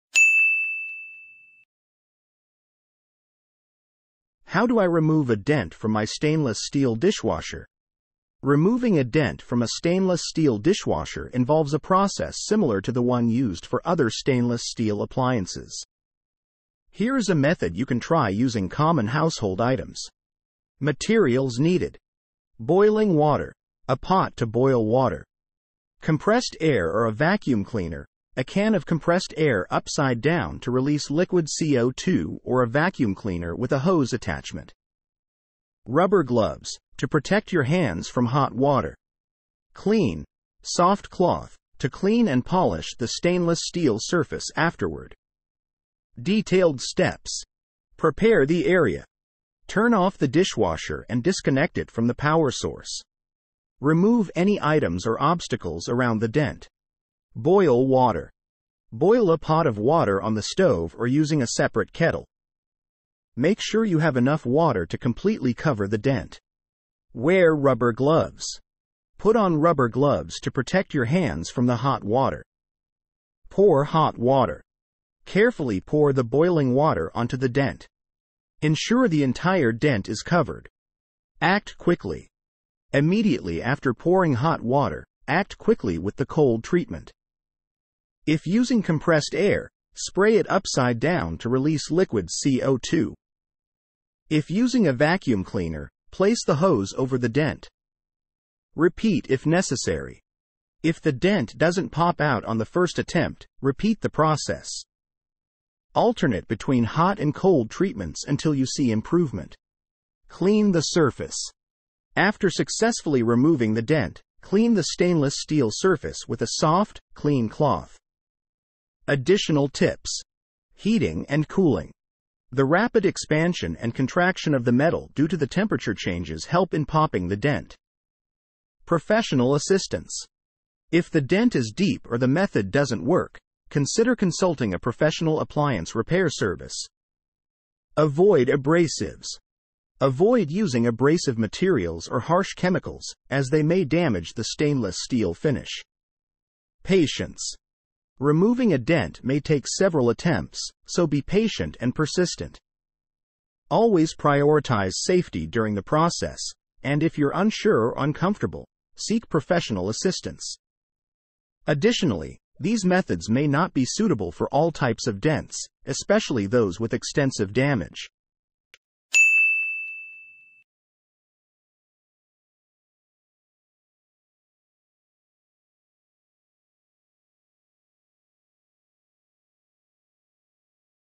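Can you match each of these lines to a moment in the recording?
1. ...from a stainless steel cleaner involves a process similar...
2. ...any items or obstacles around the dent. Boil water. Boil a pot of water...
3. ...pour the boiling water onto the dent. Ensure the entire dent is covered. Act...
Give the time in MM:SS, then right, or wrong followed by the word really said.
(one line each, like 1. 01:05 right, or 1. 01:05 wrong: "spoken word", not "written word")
1. 00:09 wrong: "dishwasher", not "cleaner"
2. 00:54 right
3. 01:15 right.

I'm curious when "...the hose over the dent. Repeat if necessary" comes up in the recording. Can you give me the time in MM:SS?
01:36.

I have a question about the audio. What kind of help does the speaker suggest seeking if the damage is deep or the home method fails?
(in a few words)
Professional appliance repair service.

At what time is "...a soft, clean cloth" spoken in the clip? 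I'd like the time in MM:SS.
01:56.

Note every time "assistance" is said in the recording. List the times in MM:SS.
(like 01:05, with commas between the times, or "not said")
02:09, 02:39.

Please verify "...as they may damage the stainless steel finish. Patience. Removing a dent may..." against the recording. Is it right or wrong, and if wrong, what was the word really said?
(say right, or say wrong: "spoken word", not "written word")
right.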